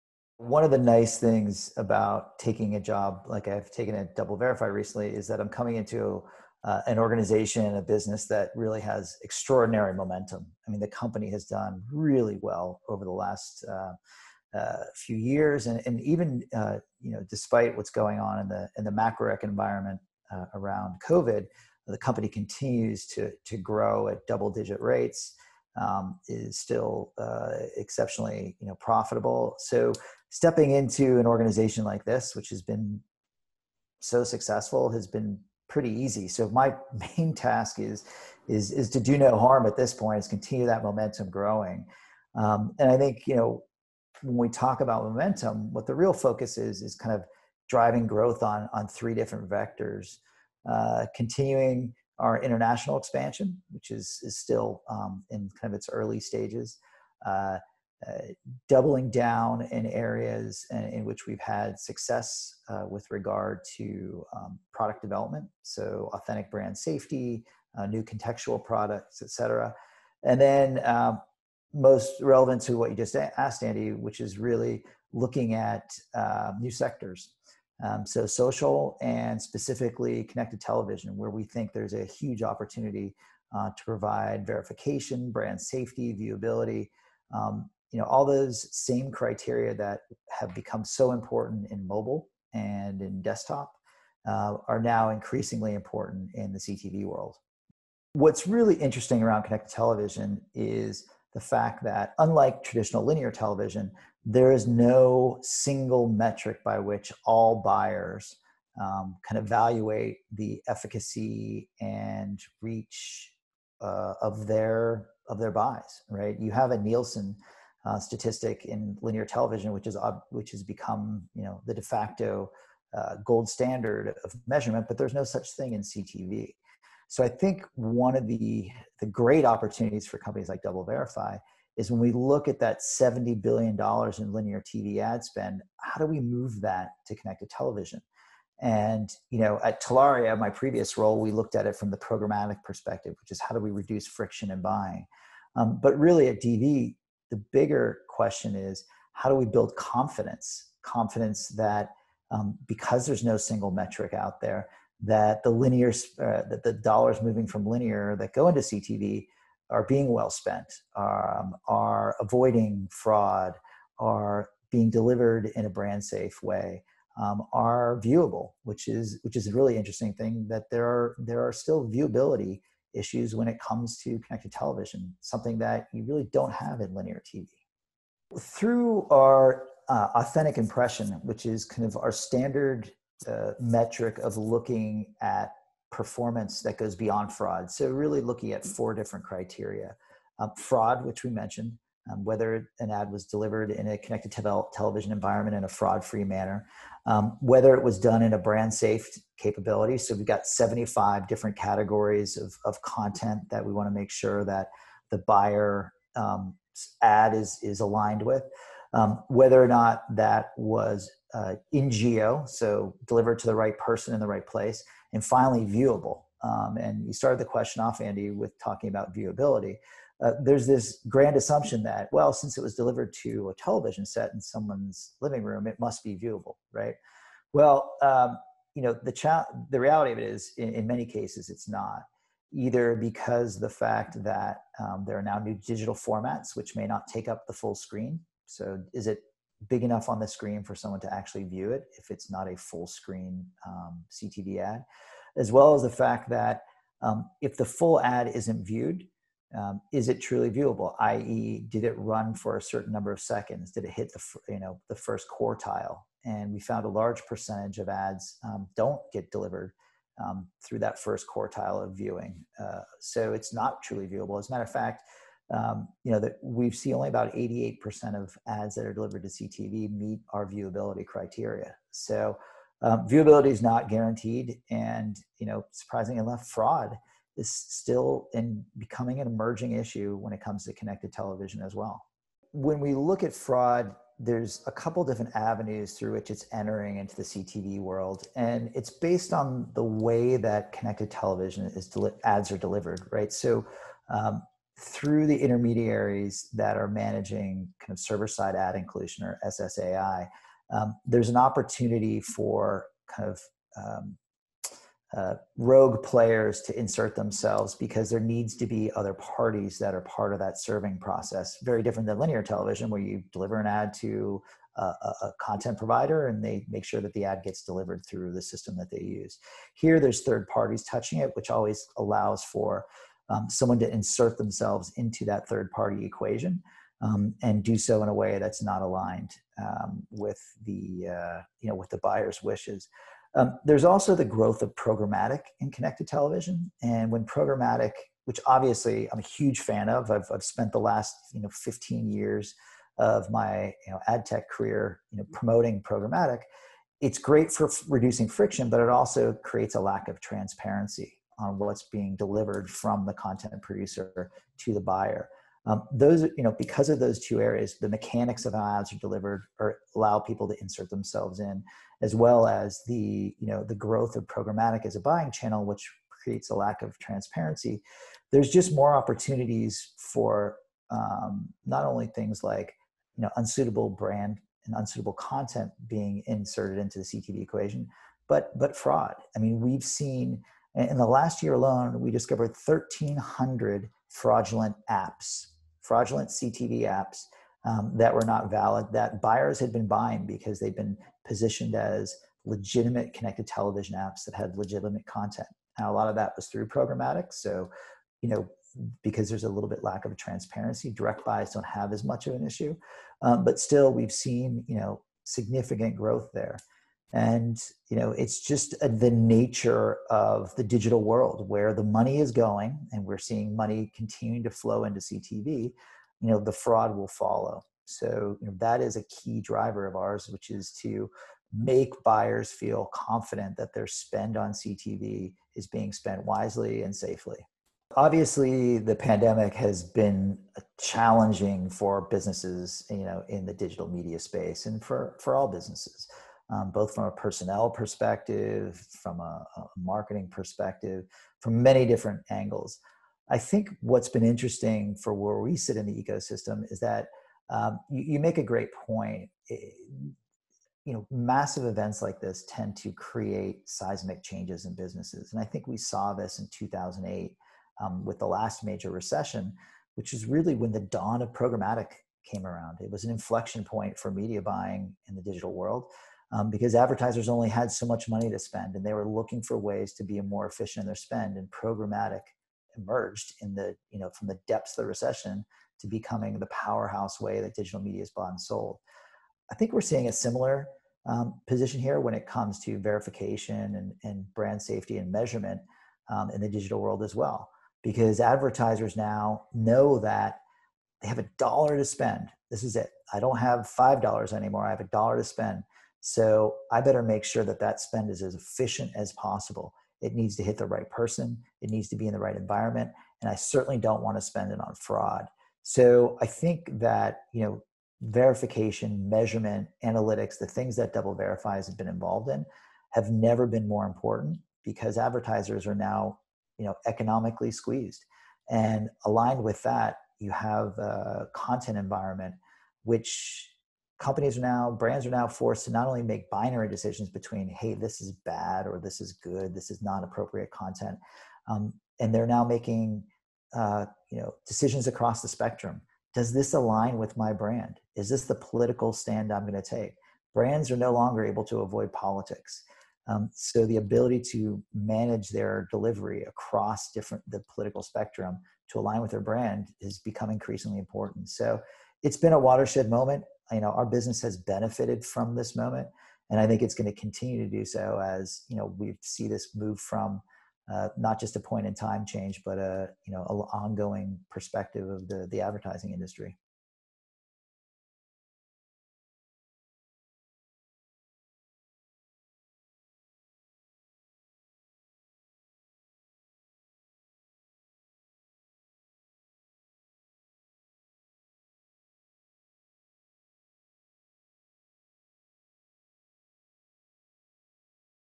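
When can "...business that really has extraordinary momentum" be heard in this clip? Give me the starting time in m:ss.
0:07.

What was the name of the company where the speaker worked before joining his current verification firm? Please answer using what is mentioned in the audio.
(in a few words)
Telaria.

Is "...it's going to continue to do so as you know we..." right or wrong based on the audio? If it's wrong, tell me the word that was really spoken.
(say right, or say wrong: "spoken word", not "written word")
right.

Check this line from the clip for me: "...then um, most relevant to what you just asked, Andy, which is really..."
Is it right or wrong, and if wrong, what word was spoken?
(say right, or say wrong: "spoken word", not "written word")
right.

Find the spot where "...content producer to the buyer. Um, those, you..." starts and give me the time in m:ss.
5:53.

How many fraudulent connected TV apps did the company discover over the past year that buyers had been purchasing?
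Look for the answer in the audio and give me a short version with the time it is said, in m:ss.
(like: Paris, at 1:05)
1,300, at 6:22.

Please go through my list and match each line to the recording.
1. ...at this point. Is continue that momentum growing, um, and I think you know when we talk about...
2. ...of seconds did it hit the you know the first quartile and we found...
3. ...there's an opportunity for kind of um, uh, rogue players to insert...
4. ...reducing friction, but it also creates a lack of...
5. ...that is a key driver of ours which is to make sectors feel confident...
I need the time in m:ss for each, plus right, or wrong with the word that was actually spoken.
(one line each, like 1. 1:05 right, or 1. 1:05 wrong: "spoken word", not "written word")
1. 0:39 right
2. 4:13 right
3. 5:01 right
4. 5:47 right
5. 6:58 wrong: "buyers", not "sectors".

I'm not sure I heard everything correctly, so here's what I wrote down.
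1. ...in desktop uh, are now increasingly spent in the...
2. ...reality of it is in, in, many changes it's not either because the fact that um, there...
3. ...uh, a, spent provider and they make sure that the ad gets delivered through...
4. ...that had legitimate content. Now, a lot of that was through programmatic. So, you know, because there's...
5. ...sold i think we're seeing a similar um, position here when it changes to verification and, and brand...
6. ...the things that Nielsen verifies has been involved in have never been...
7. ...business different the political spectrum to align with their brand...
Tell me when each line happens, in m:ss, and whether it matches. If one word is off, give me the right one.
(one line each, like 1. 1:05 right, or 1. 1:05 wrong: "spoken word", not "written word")
1. 1:33 wrong: "important", not "spent"
2. 3:49 wrong: "cases", not "changes"
3. 5:14 wrong: "content", not "spent"
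4. 6:34 right
5. 7:58 wrong: "comes", not "changes"
6. 8:30 wrong: "Double", not "Nielsen"
7. 9:06 wrong: "across", not "business".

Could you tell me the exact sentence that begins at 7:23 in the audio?
I think what's been interesting for where we sit in the ecosystem is that um, you, you, make a great point.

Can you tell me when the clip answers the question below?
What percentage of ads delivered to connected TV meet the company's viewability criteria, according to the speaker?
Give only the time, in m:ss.
4:27.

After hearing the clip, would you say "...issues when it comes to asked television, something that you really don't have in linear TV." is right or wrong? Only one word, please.
wrong.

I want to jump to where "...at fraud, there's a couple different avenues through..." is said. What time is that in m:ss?
4:43.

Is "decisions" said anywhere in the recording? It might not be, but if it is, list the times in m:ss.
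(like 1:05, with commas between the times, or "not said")
8:46, 8:54.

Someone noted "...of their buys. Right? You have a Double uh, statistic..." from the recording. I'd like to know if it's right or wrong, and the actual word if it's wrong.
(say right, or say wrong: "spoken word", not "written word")
wrong: "Nielsen", not "Double".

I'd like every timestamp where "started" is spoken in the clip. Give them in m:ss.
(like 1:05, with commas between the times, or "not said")
3:37.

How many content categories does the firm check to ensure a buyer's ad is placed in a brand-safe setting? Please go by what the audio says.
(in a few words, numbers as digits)
75.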